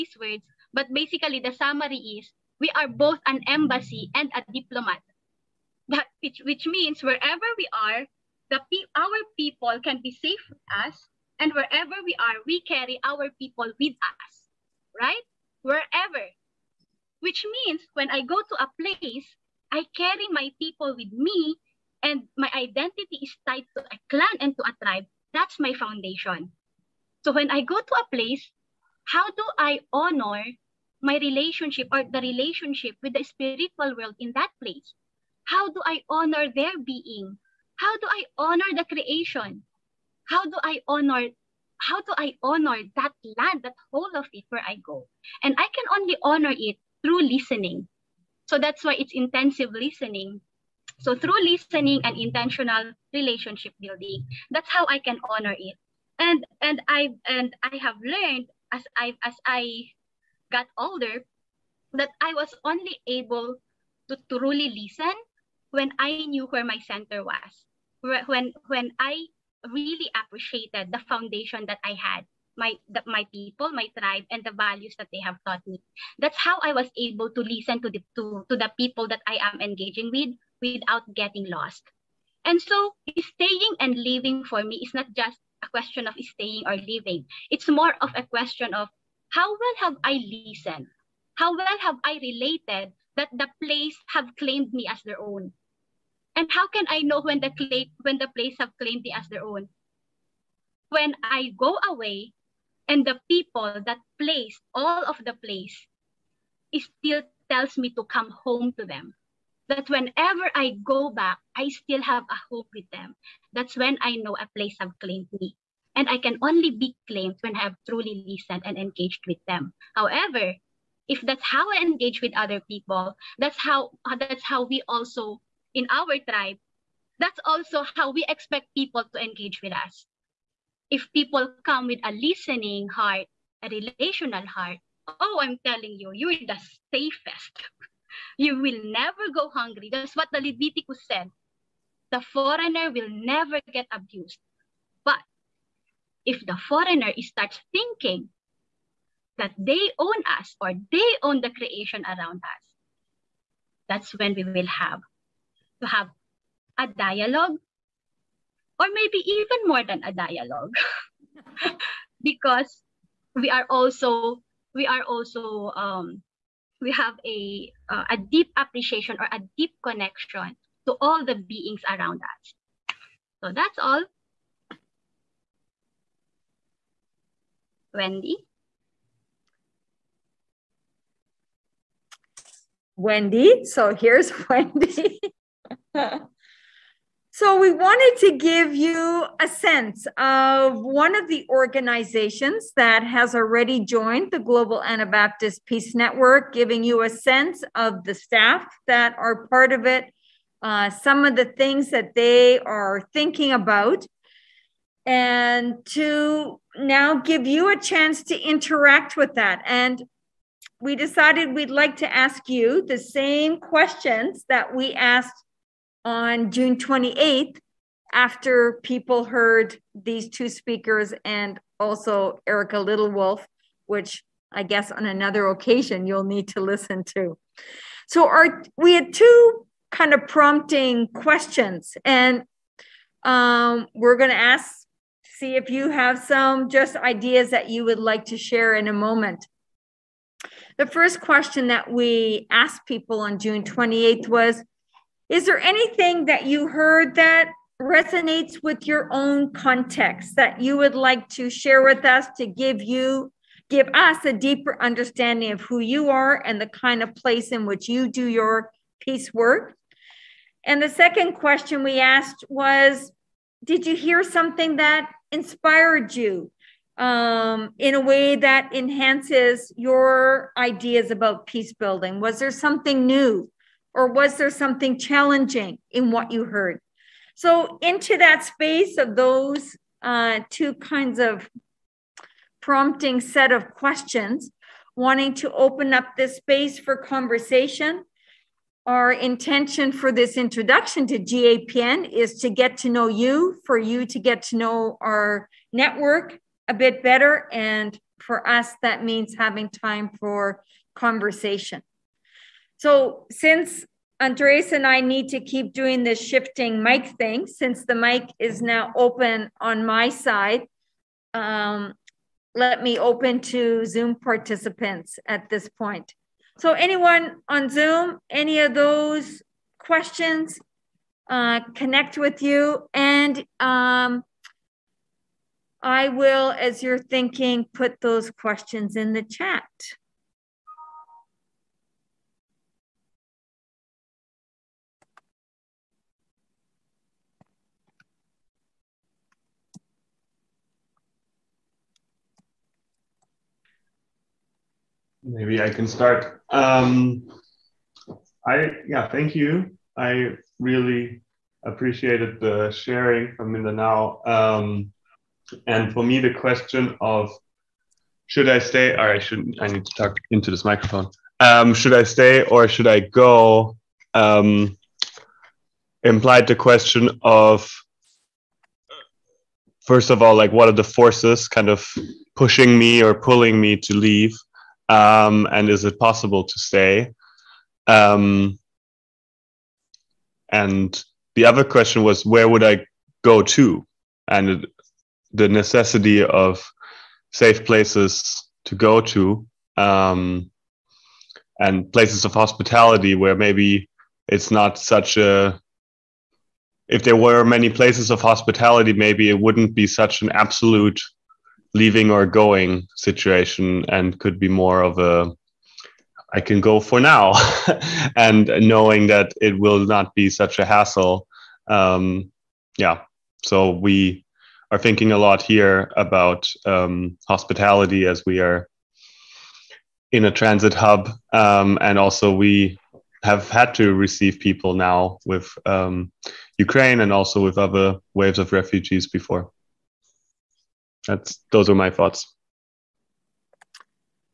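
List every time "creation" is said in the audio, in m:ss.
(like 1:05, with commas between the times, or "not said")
0:38, 2:31.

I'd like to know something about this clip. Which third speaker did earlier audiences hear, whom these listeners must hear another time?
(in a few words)
Erica Littlewolf.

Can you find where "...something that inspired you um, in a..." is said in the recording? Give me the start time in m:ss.
4:24.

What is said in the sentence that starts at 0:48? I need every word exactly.
So that's why it's intensive listening.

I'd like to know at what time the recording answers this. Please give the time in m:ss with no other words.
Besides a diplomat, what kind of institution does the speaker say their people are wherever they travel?
0:03.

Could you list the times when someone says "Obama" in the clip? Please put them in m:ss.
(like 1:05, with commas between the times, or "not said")
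not said.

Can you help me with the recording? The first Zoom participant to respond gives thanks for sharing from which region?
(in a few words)
Mindanao.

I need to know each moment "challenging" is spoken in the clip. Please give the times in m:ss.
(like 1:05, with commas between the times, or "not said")
4:34.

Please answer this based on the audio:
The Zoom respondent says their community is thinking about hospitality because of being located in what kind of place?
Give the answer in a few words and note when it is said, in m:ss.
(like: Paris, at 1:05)
a transit hub, at 7:00.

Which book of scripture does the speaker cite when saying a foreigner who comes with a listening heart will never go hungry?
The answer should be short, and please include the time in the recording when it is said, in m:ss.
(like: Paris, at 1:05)
Leviticus, at 2:20.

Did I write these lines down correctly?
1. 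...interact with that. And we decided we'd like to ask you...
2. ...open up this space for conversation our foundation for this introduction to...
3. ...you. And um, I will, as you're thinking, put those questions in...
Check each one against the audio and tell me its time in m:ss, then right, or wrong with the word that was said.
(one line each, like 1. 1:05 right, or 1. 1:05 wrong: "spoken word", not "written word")
1. 3:28 right
2. 4:45 wrong: "intention", not "foundation"
3. 5:22 right.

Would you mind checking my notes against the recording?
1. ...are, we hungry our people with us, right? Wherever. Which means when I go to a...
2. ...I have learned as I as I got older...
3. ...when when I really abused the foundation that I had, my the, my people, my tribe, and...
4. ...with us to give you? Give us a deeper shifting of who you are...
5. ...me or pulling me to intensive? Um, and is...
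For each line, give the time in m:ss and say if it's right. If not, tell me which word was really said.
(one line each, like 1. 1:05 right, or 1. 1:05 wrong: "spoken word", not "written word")
1. 0:12 wrong: "carry", not "hungry"
2. 0:57 right
3. 1:08 wrong: "appreciated", not "abused"
4. 4:11 wrong: "understanding", not "shifting"
5. 6:12 wrong: "leave", not "intensive".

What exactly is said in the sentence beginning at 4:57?
And for us, that means having time for conversation.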